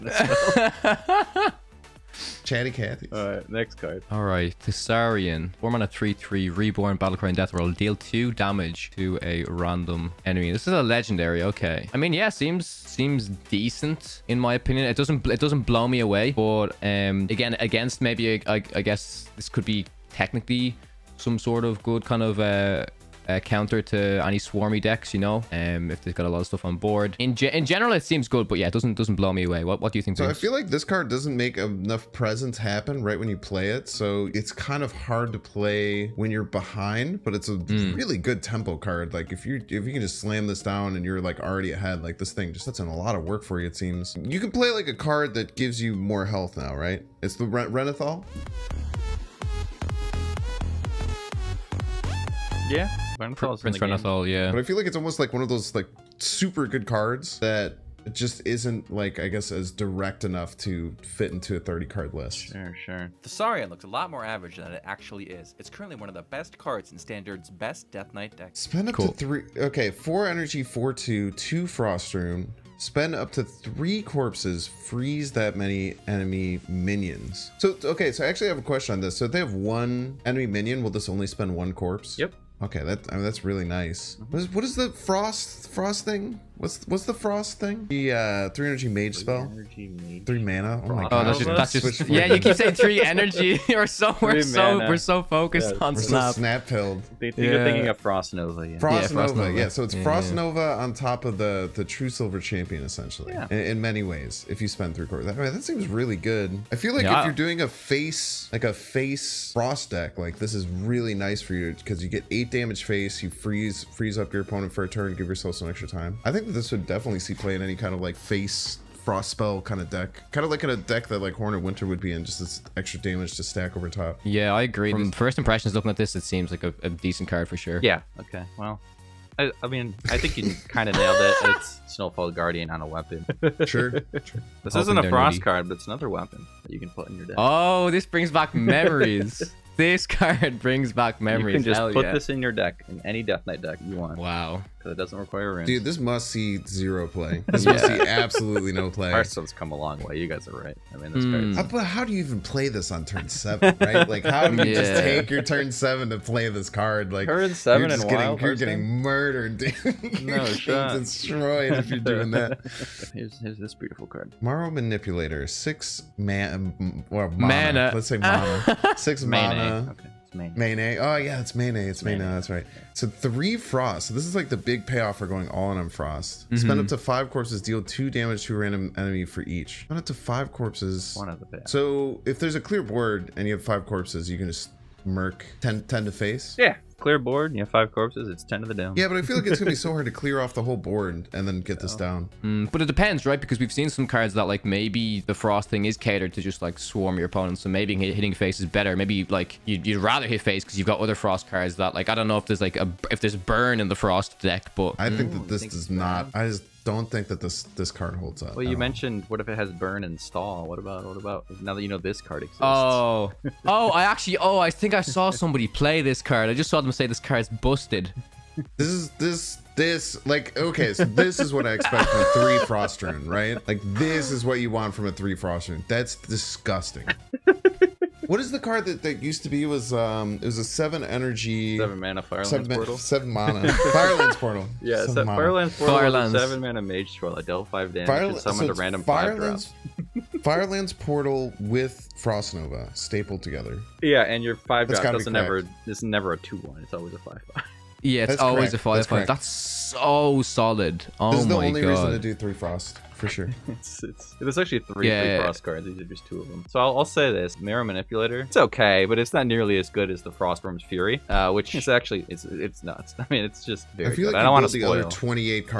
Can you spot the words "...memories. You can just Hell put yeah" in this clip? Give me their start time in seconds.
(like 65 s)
141 s.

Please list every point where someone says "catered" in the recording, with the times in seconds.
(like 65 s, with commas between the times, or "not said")
195 s.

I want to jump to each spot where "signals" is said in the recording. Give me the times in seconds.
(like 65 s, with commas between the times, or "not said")
not said.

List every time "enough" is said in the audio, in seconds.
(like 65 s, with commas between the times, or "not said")
31 s, 60 s.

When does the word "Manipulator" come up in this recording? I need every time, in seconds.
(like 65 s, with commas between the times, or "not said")
164 s, 257 s.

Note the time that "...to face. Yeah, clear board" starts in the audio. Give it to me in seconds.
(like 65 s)
186 s.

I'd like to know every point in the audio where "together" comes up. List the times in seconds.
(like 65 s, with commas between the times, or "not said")
243 s.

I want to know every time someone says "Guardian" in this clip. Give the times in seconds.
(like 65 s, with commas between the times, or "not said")
132 s.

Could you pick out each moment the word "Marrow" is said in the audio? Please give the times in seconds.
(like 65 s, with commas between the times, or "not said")
164 s, 257 s.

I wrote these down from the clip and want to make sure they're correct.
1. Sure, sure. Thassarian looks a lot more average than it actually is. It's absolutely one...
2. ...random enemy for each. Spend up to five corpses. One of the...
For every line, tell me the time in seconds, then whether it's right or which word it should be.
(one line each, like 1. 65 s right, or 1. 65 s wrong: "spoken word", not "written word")
1. 62 s wrong: "currently", not "absolutely"
2. 178 s right.